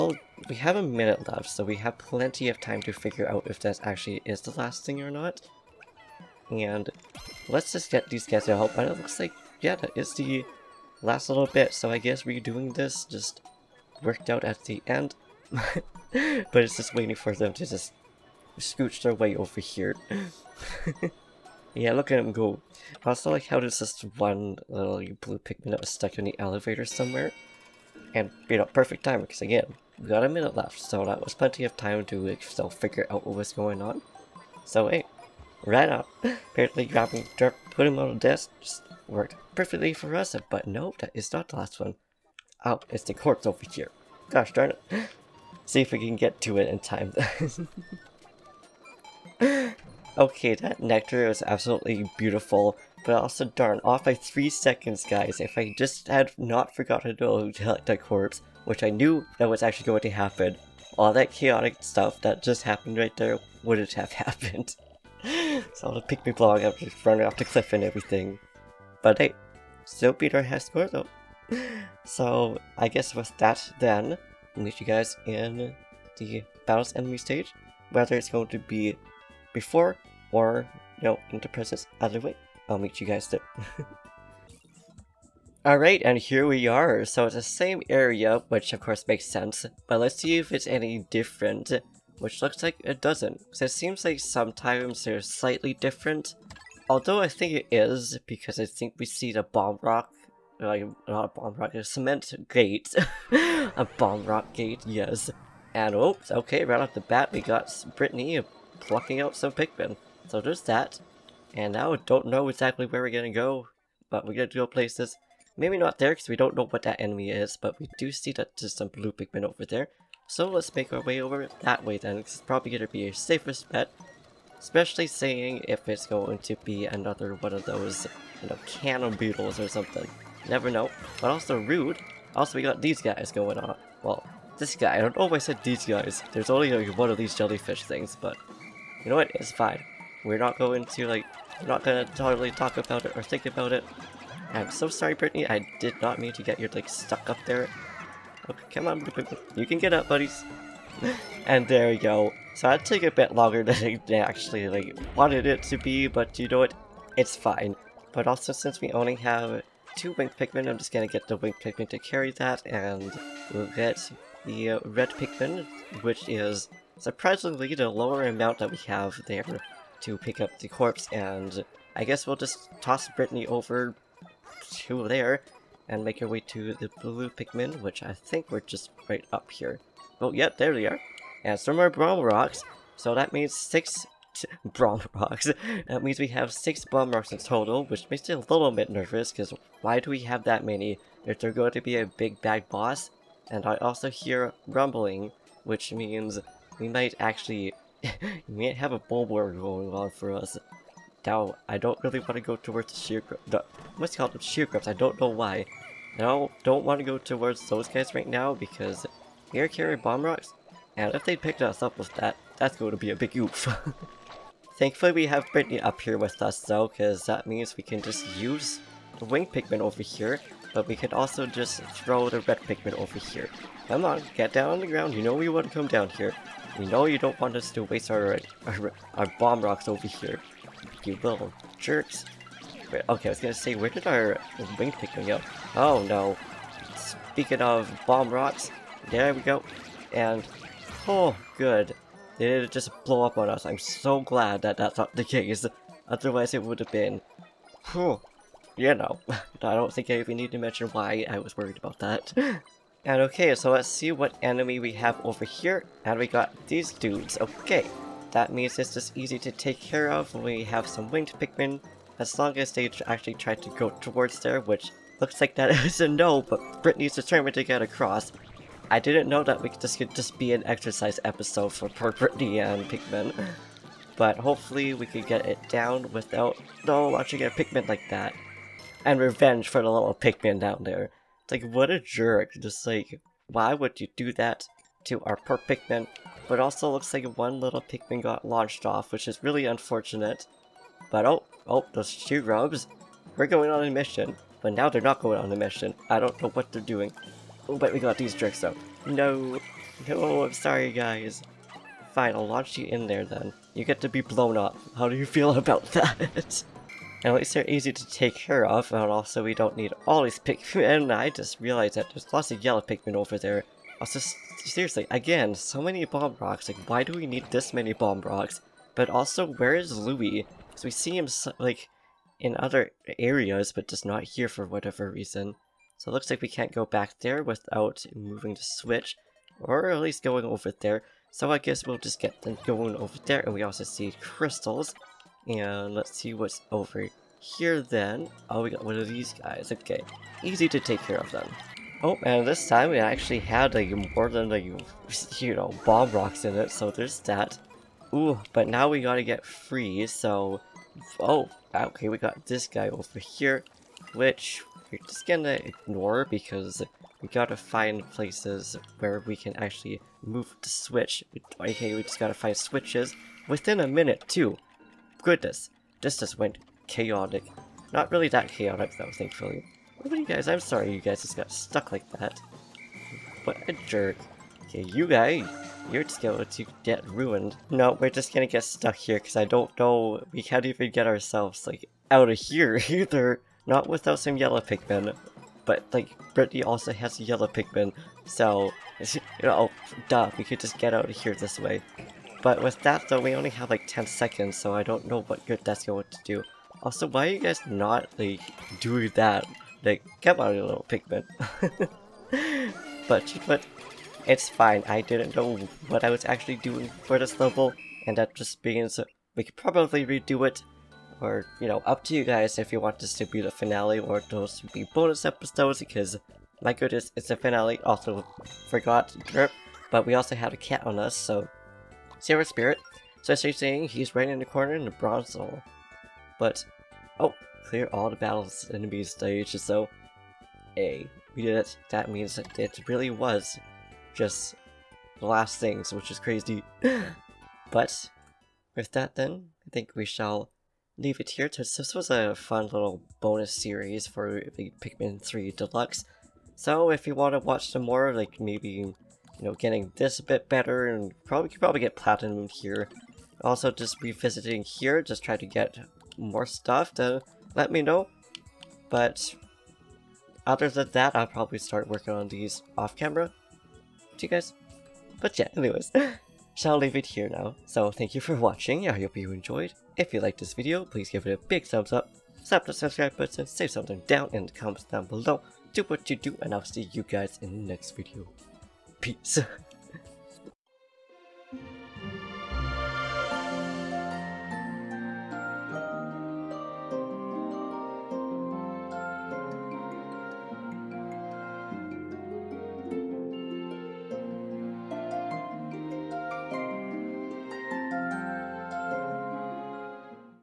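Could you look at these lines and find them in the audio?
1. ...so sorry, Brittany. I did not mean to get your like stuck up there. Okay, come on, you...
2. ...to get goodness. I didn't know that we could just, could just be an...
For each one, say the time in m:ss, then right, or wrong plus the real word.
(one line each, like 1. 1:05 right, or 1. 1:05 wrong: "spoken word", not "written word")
1. 2:24 right
2. 4:27 wrong: "across", not "goodness".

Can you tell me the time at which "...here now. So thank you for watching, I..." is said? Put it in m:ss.
7:47.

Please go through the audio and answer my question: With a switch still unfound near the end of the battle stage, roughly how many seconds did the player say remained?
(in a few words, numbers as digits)
10.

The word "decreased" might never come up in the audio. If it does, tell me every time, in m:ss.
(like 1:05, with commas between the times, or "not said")
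not said.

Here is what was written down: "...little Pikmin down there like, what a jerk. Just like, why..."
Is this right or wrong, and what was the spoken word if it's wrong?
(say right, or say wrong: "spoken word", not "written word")
right.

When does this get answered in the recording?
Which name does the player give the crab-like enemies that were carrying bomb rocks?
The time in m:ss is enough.
3:24.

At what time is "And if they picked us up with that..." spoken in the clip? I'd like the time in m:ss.
3:30.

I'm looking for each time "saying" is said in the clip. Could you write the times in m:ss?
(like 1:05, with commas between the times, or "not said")
2:05, 7:03.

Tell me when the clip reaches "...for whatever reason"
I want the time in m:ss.
5:24.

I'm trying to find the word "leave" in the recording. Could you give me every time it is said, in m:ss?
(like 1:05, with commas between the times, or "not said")
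7:20, 7:46.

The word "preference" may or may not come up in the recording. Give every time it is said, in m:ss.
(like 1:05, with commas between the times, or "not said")
not said.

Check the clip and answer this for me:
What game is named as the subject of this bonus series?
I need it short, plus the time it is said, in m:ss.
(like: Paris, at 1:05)
Pikmin 3 Deluxe, at 7:24.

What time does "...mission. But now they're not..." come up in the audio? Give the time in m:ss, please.
4:53.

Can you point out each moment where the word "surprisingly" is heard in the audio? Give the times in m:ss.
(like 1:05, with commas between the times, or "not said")
2:46.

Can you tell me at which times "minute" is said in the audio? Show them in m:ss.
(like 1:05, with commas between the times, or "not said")
0:00, 0:30, 6:03.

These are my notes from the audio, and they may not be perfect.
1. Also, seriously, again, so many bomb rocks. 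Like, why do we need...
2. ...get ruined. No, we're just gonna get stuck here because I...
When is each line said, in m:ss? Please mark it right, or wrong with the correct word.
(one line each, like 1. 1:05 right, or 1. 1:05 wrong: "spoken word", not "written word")
1. 5:14 right
2. 6:16 right.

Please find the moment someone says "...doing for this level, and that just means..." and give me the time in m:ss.
6:46.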